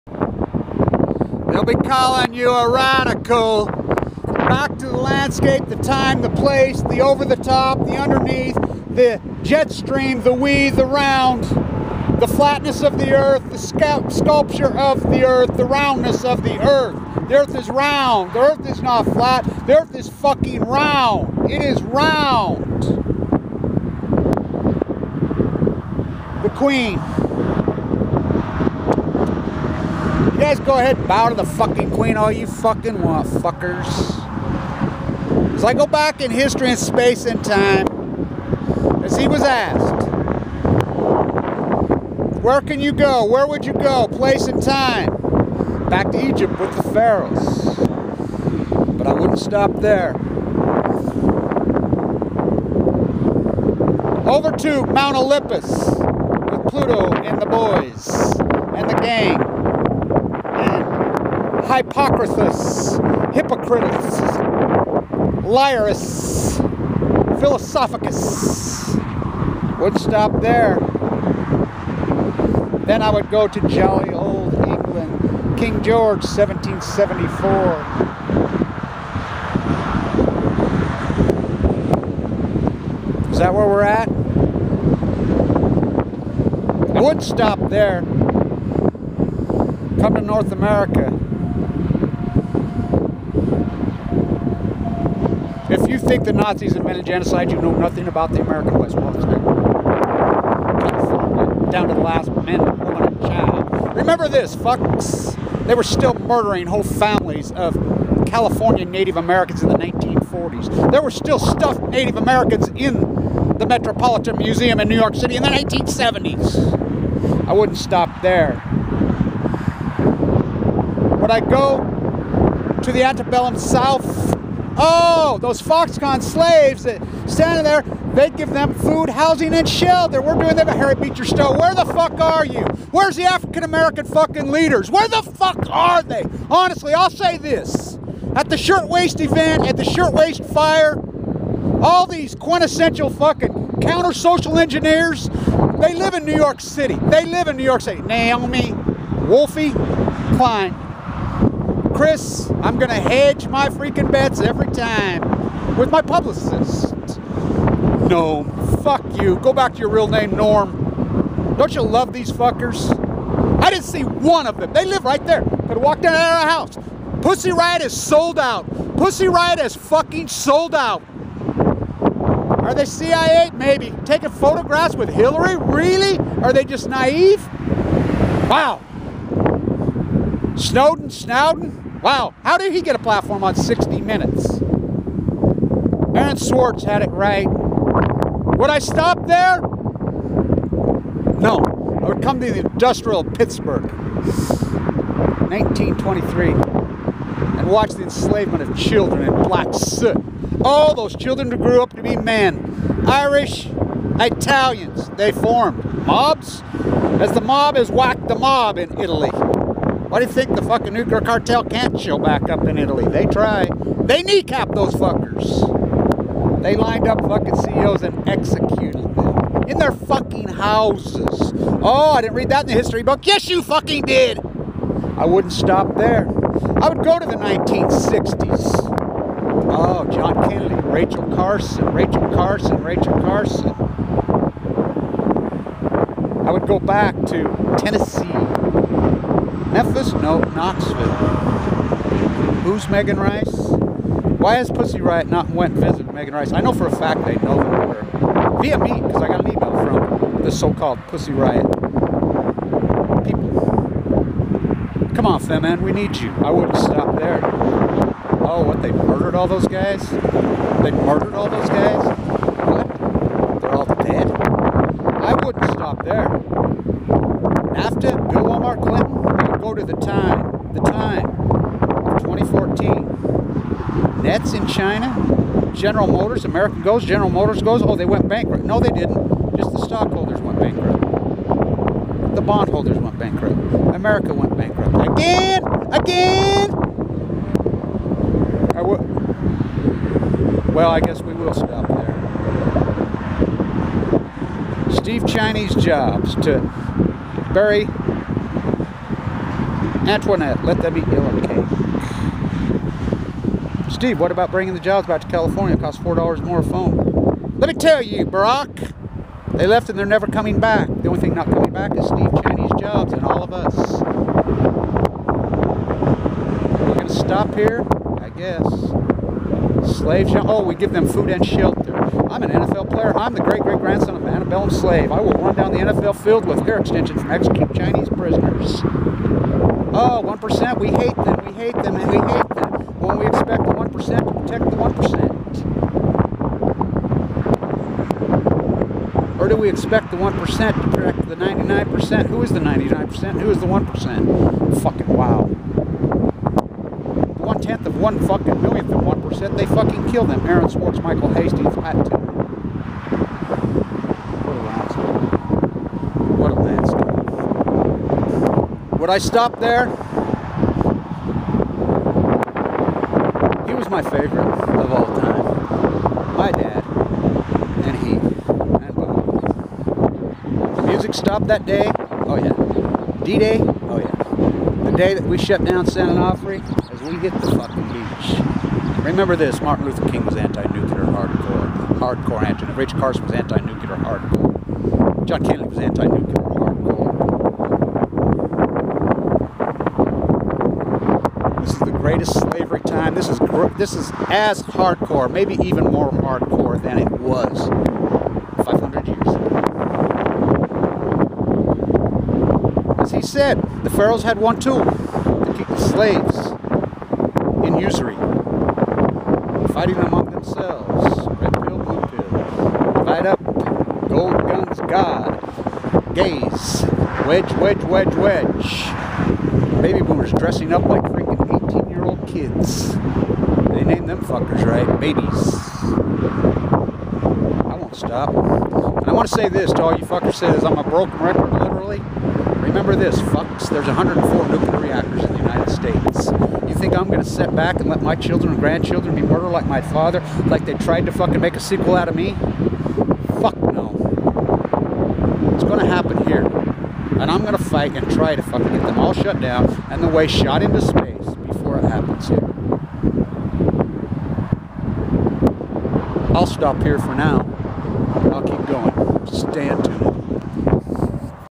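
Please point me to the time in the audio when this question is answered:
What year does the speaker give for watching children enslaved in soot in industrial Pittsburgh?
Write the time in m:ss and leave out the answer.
3:15.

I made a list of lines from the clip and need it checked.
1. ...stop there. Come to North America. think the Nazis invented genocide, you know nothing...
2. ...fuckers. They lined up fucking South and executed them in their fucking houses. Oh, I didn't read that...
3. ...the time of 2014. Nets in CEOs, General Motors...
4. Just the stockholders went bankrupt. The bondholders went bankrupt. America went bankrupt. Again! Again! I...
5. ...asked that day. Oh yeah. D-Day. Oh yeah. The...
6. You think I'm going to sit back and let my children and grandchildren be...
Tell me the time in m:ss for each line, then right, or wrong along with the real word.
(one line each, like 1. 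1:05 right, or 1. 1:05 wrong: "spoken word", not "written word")
1. 1:27 right
2. 3:34 wrong: "CEOs", not "South"
3. 4:30 wrong: "China", not "CEOs"
4. 4:39 right
5. 6:11 wrong: "stopped", not "asked"
6. 7:16 right.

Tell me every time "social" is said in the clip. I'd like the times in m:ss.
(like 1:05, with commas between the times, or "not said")
2:24.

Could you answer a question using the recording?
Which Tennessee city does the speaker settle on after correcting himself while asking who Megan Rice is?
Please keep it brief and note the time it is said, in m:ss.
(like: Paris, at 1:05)
Knoxville, at 4:00.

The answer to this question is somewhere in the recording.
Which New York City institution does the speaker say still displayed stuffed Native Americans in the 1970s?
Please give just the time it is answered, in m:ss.
1:53.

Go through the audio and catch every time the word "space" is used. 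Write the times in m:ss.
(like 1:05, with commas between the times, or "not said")
0:36, 7:30.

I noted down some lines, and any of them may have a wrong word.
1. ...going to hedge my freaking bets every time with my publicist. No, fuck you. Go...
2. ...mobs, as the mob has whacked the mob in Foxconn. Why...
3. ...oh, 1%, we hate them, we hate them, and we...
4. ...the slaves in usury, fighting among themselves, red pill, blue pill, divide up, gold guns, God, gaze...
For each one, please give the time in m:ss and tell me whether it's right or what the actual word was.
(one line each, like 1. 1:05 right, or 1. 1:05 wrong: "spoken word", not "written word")
1. 2:32 right
2. 3:26 wrong: "Italy", not "Foxconn"
3. 5:29 right
4. 6:45 right.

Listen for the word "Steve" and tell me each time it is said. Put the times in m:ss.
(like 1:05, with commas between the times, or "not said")
4:54, 5:03, 5:12.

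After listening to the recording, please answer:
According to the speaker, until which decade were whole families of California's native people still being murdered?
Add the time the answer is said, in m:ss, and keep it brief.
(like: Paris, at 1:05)
1940s, at 1:49.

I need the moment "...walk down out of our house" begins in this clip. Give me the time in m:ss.
2:45.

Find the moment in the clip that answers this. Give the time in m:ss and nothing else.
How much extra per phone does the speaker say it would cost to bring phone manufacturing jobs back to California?
5:06.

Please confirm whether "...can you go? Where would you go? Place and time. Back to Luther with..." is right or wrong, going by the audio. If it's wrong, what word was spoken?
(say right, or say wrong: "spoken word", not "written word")
wrong: "Egypt", not "Luther".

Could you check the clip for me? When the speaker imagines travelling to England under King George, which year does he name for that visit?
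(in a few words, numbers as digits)
1774.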